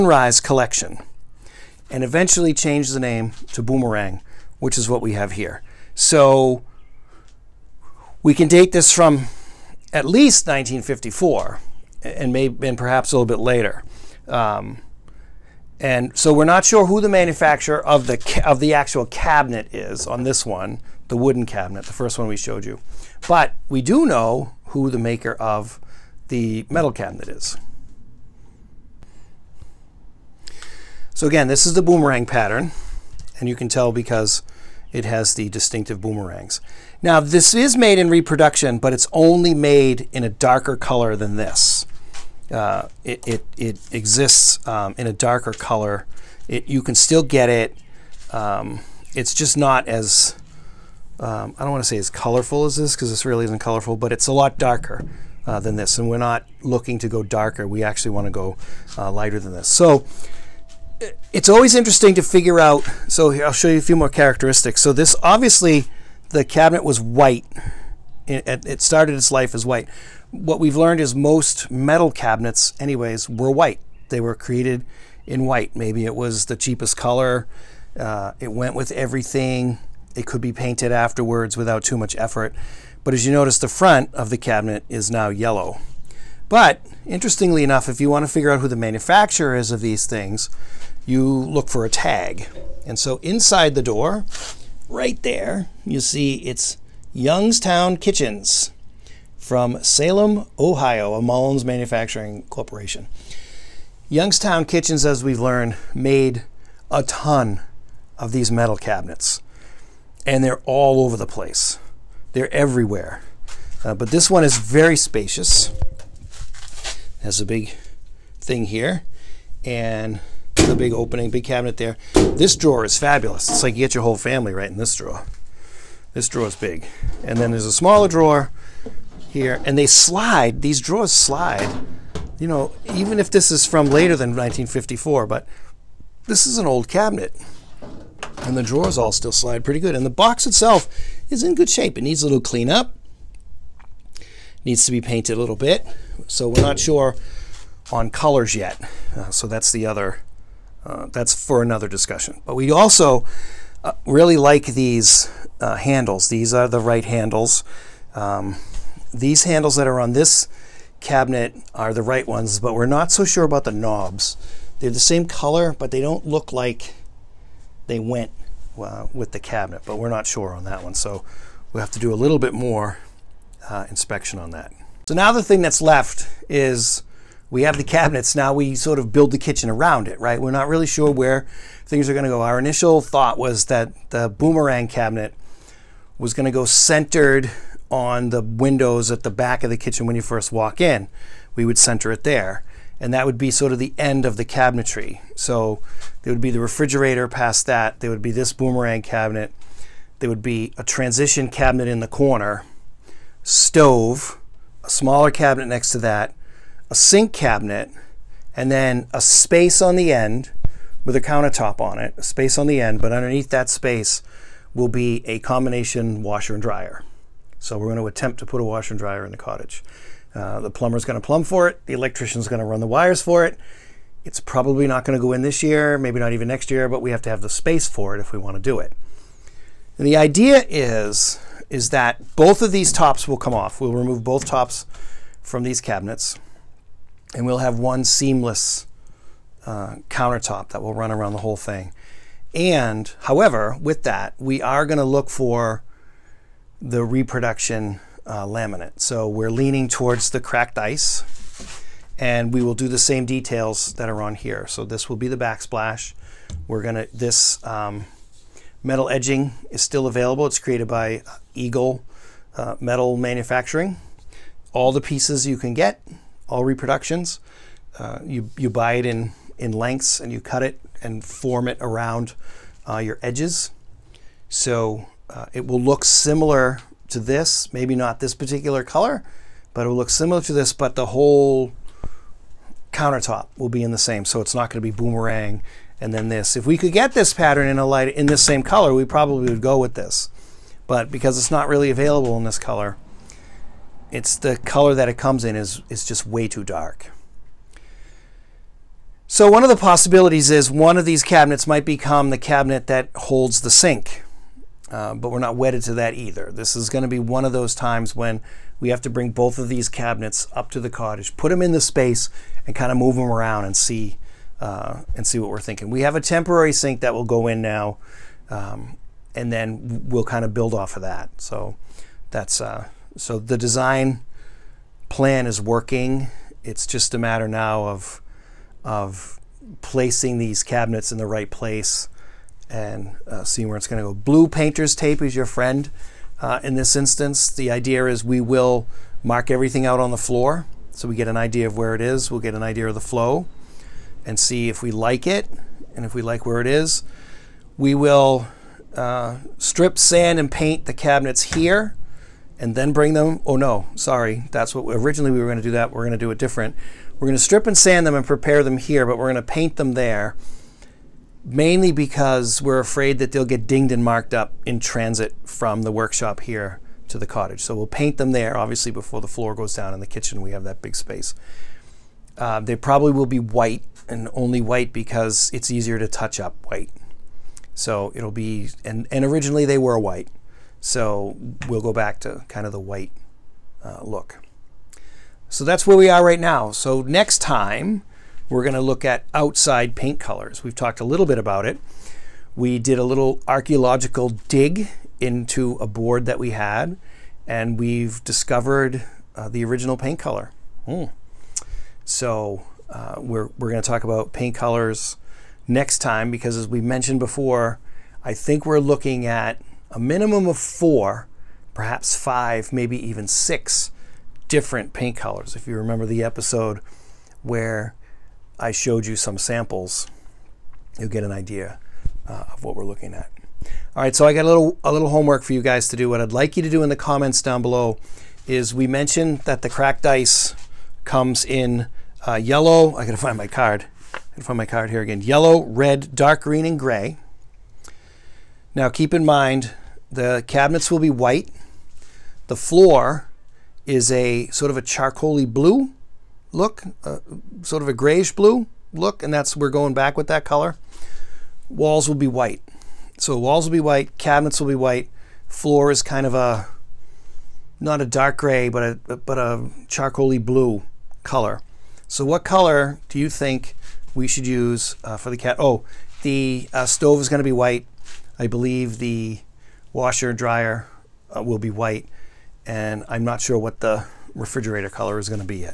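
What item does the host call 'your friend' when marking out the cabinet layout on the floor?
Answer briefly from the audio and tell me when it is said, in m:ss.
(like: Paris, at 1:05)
blue painter's tape, at 5:34.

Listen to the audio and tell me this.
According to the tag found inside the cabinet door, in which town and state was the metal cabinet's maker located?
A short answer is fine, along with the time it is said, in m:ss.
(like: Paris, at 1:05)
Salem, Ohio, at 1:39.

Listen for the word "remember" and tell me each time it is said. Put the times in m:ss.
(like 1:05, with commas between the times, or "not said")
6:55.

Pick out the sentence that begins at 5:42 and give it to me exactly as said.
We'll get an idea of the flow and see if we like it and if we like where it is.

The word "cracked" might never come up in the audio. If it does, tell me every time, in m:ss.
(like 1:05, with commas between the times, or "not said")
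4:10, 7:09.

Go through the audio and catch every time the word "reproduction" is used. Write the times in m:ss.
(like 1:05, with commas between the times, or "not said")
0:38, 4:07, 4:26.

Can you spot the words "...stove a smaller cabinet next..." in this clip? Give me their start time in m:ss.
3:23.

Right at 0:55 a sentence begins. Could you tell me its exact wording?
And we're not looking to go darker.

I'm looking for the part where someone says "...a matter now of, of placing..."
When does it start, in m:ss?
5:27.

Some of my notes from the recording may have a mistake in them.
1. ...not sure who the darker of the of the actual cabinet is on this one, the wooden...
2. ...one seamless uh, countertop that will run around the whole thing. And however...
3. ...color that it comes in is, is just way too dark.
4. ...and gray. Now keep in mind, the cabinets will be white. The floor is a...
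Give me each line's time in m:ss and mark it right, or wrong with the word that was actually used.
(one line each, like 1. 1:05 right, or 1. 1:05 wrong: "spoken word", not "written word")
1. 0:16 wrong: "manufacturer", not "darker"
2. 3:57 right
3. 4:54 right
4. 7:16 right.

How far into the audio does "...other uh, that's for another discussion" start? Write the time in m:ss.
2:29.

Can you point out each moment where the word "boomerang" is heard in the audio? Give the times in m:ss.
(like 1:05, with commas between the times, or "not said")
0:03, 0:31, 0:35, 3:04, 3:18, 4:44.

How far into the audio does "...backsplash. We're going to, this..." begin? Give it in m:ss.
4:15.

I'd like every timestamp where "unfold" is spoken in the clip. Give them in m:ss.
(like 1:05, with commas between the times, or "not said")
not said.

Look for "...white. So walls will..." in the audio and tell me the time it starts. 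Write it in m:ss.
7:32.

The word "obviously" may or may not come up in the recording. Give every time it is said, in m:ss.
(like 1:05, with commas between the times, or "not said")
1:05, 6:08.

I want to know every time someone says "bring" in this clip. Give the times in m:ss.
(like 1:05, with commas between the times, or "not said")
5:09, 5:52.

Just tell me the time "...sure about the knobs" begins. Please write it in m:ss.
2:43.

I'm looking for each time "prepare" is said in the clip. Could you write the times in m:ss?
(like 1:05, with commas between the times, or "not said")
5:58.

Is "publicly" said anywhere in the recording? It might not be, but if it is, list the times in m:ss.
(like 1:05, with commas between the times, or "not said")
not said.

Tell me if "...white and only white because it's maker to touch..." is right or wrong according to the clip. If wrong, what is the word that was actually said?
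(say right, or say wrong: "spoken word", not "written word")
wrong: "easier", not "maker".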